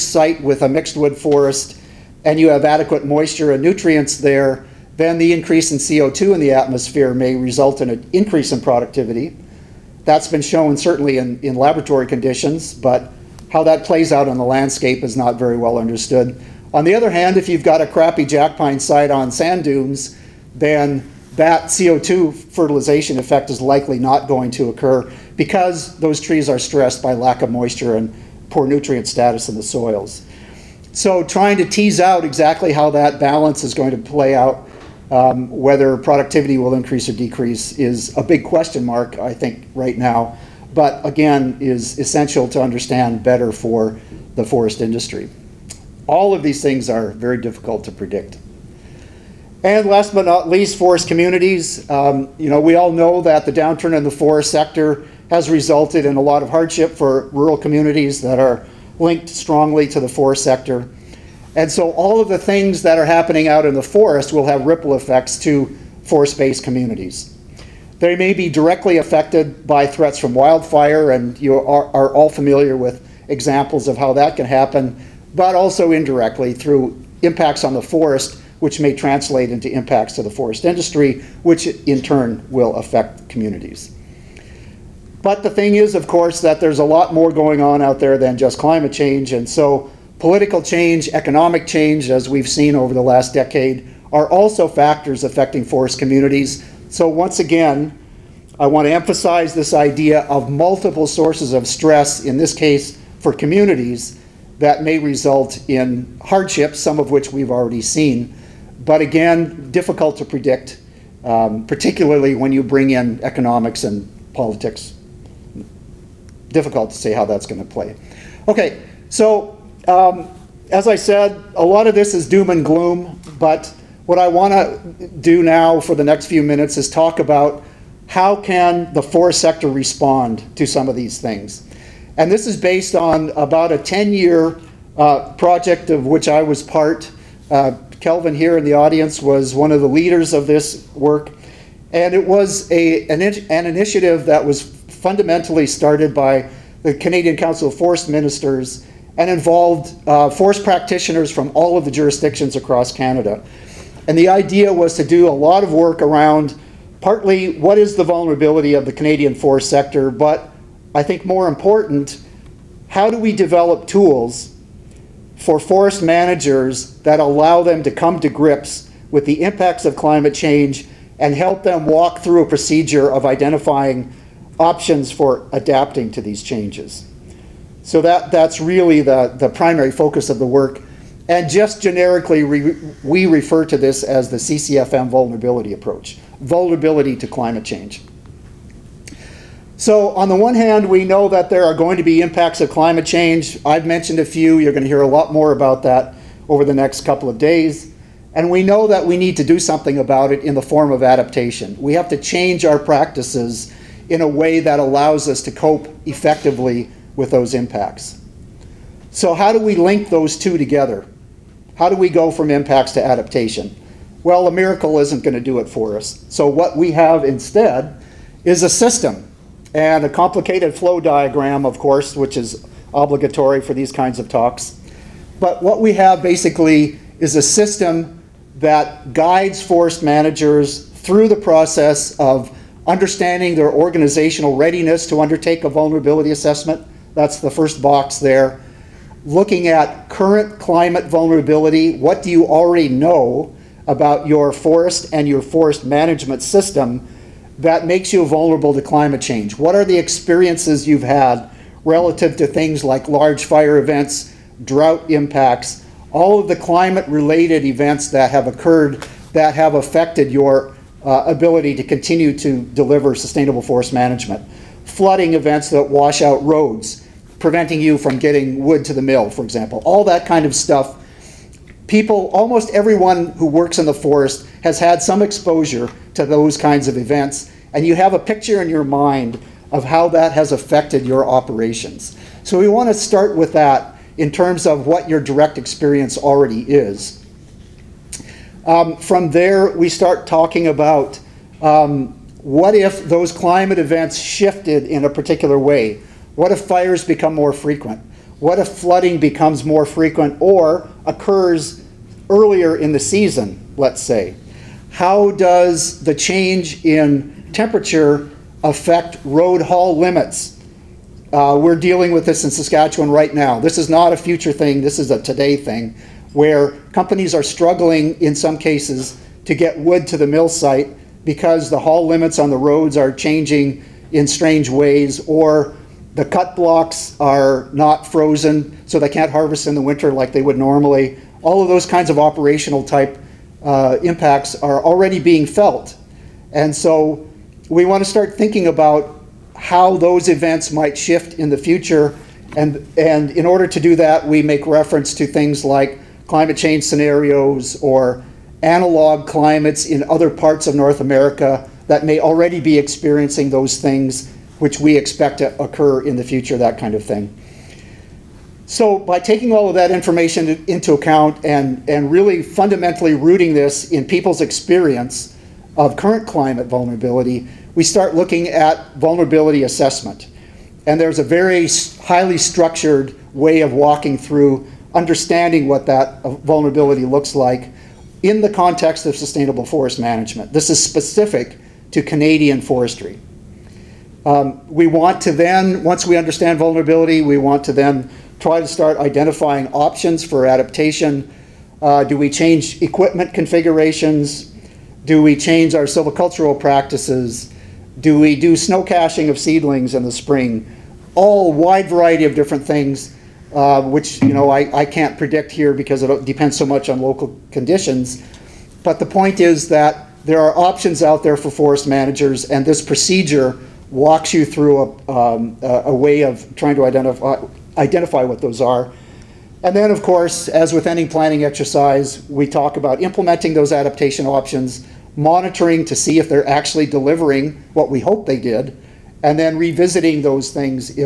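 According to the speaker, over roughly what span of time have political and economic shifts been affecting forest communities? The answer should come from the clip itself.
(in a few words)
the last decade.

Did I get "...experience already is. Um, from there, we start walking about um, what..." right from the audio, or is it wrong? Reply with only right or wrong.
wrong.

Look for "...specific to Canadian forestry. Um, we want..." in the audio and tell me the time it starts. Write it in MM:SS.
06:20.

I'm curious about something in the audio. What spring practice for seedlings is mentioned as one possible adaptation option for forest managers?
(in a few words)
snow caching.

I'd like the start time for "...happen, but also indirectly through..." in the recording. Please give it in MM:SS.
01:14.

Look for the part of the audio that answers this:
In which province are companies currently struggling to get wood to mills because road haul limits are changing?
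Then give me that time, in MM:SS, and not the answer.
05:12.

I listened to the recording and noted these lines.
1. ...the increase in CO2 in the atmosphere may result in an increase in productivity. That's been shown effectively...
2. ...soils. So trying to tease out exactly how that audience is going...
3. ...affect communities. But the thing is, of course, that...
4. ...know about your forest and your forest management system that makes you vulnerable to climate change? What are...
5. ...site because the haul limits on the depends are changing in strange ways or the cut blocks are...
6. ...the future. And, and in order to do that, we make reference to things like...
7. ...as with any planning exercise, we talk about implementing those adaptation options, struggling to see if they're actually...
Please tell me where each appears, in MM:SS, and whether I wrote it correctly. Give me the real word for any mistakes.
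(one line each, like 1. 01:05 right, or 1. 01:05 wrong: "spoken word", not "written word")
1. 00:05 wrong: "certainly", not "effectively"
2. 00:29 wrong: "balance", not "audience"
3. 01:22 right
4. 04:02 right
5. 05:20 wrong: "roads", not "depends"
6. 05:41 right
7. 07:00 wrong: "monitoring", not "struggling".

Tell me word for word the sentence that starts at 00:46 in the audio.
All of these things are very difficult to predict.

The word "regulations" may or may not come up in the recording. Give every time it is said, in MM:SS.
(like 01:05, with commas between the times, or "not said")
not said.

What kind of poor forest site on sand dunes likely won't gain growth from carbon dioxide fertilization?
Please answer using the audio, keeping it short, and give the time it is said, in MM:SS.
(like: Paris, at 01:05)
jackpine site, at 00:18.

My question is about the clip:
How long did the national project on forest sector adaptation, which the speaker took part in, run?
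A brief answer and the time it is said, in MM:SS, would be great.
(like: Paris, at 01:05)
about 10 years, at 02:13.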